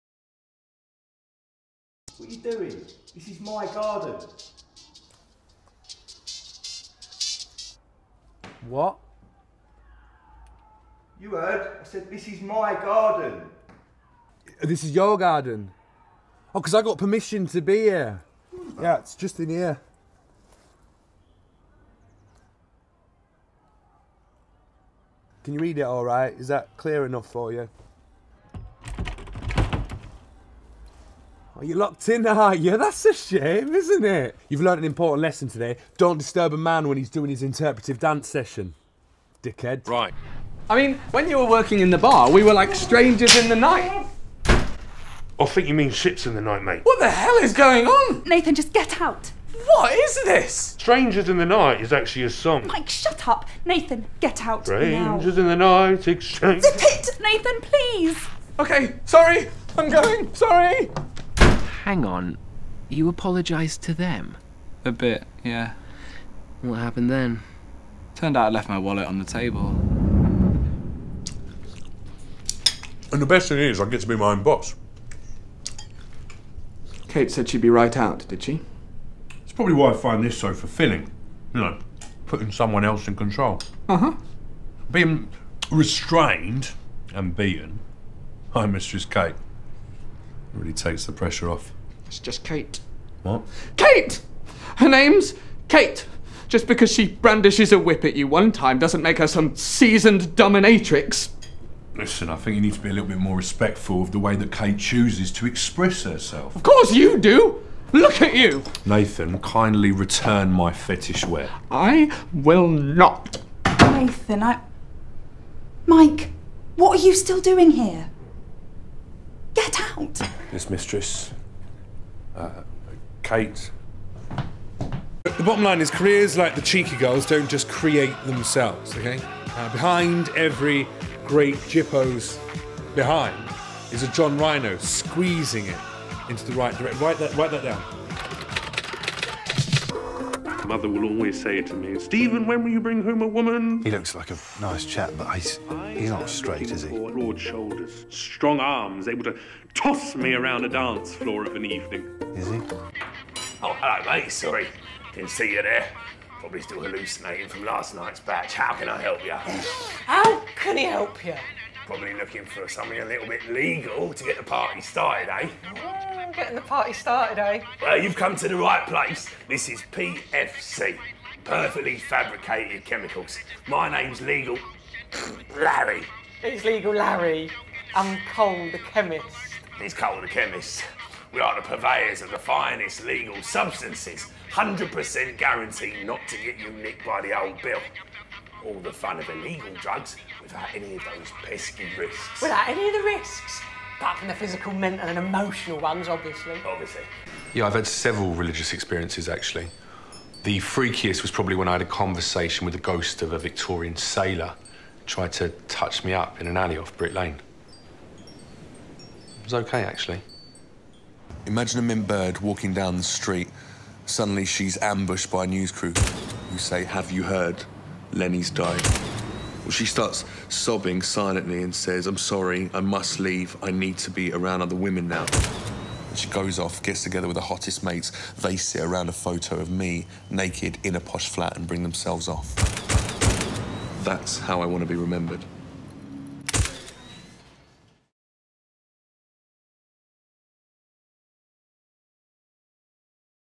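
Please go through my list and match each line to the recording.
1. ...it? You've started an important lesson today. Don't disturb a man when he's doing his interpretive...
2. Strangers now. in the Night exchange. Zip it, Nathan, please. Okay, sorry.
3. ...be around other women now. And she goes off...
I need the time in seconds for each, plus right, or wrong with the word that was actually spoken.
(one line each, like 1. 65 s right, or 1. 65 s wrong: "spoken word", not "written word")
1. 34 s wrong: "learned", not "started"
2. 54 s right
3. 224 s right.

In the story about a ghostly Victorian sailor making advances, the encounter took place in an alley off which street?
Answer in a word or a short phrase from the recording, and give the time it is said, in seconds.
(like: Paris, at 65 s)
Brick Lane, at 206 s.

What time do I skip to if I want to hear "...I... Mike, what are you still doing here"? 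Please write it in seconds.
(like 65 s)
114 s.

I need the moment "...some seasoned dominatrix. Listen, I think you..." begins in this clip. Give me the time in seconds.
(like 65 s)
99 s.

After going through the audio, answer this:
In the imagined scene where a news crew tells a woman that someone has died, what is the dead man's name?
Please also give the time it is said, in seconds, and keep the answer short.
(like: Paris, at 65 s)
Lenny, at 218 s.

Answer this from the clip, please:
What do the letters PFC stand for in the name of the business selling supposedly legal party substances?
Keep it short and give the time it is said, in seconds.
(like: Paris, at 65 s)
Perfectly Fabricated Chemicals, at 171 s.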